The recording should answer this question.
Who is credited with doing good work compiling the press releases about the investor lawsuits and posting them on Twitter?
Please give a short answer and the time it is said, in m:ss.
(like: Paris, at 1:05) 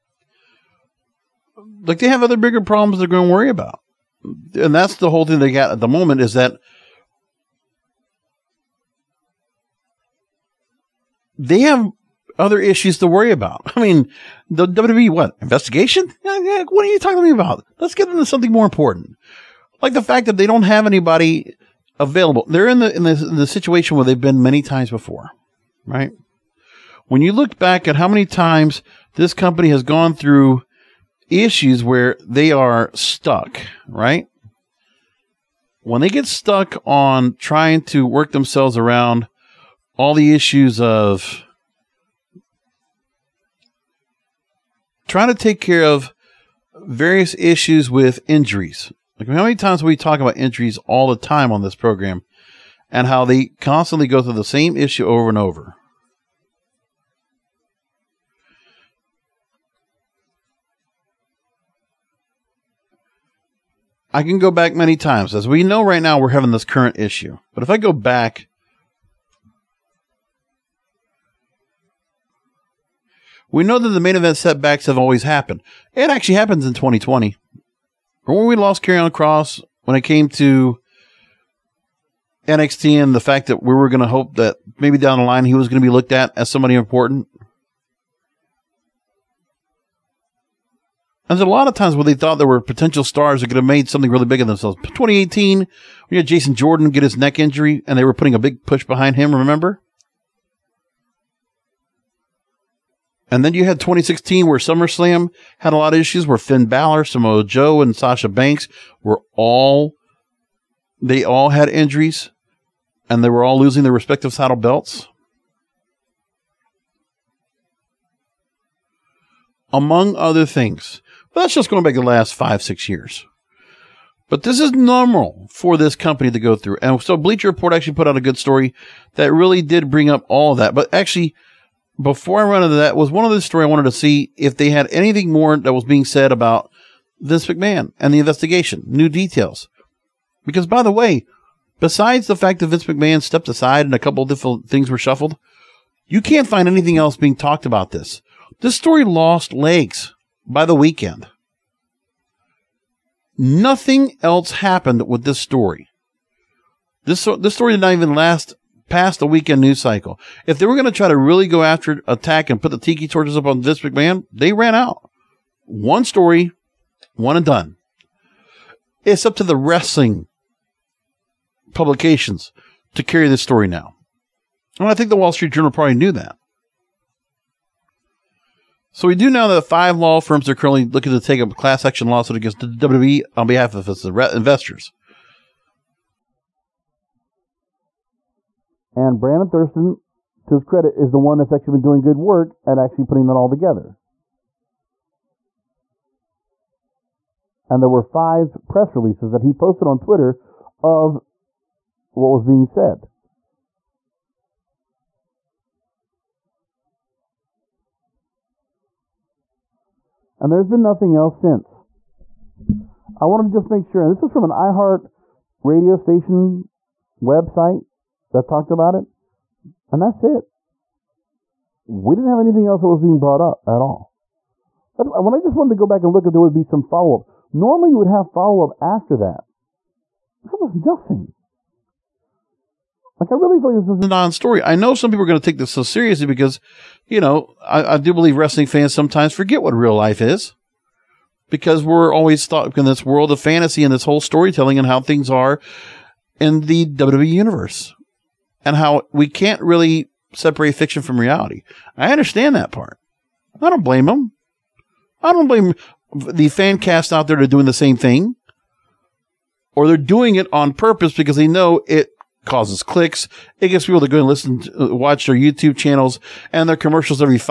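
Brandon Thurston, at 3:09.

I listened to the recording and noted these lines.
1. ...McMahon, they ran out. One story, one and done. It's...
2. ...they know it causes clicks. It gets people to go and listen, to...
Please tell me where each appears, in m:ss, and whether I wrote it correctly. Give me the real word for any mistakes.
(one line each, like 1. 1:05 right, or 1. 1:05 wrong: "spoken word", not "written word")
1. 2:43 right
2. 4:21 right.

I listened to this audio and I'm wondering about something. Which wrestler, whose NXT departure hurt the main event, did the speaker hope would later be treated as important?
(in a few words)
Karrion Kross.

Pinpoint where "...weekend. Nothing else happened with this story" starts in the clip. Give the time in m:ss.
2:30.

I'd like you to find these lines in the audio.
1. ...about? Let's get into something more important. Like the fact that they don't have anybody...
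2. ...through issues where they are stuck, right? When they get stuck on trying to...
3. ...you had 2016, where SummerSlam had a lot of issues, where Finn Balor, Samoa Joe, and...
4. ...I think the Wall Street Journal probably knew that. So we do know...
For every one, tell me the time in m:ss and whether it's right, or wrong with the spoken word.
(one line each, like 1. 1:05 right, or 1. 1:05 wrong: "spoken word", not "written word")
1. 0:17 right
2. 0:30 right
3. 1:43 right
4. 2:54 right.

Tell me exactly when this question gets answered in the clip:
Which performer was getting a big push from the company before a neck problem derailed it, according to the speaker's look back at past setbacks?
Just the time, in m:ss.
1:36.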